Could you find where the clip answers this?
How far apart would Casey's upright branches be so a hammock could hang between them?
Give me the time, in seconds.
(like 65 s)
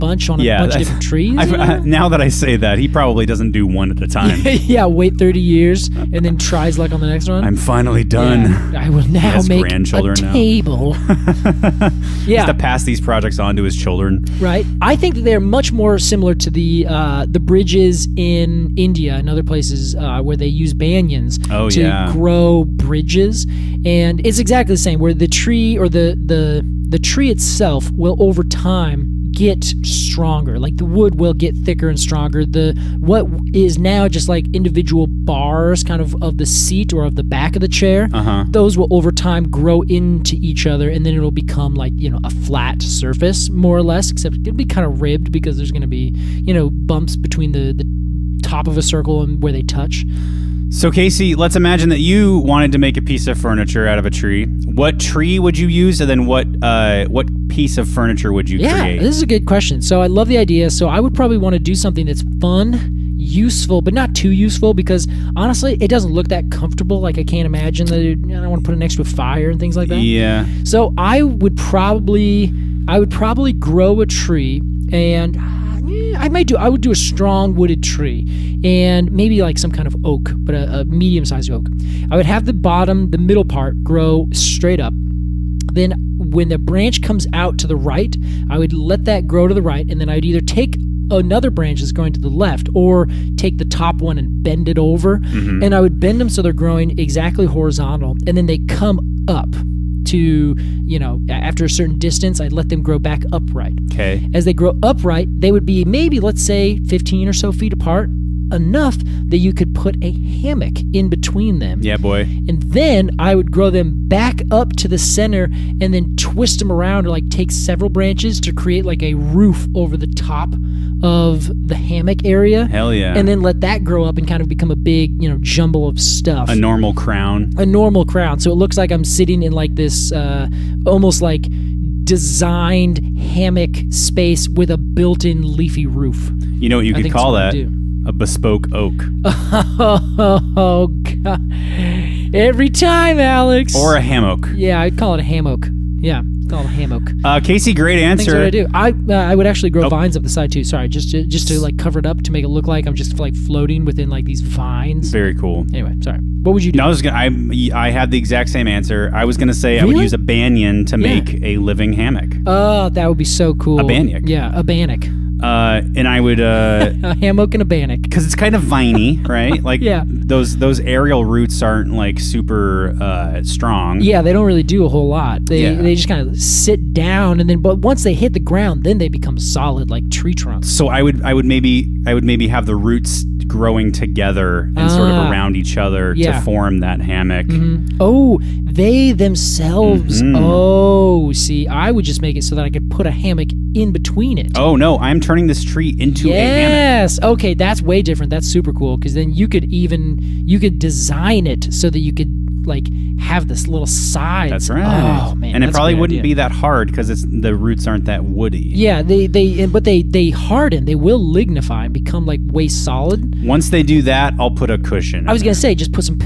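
106 s.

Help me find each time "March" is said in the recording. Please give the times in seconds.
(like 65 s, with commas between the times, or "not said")
not said.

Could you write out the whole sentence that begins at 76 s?
I would do a strong wooded tree and maybe like some kind of oak, but a, a medium sized oak.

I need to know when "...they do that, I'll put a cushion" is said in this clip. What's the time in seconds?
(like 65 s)
213 s.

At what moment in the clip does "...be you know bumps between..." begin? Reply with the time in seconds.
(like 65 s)
45 s.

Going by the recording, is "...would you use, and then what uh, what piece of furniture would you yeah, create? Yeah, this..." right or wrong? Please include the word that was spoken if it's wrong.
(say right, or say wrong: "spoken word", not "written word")
right.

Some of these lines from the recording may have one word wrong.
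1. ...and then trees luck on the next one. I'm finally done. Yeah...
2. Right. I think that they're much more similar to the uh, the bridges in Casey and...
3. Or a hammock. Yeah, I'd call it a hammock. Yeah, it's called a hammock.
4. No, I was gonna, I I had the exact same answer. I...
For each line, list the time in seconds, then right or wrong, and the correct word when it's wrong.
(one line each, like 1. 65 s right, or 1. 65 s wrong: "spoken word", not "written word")
1. 6 s wrong: "tries", not "trees"
2. 14 s wrong: "India", not "Casey"
3. 143 s right
4. 156 s right.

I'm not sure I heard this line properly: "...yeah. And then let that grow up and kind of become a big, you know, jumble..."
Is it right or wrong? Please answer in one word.
right.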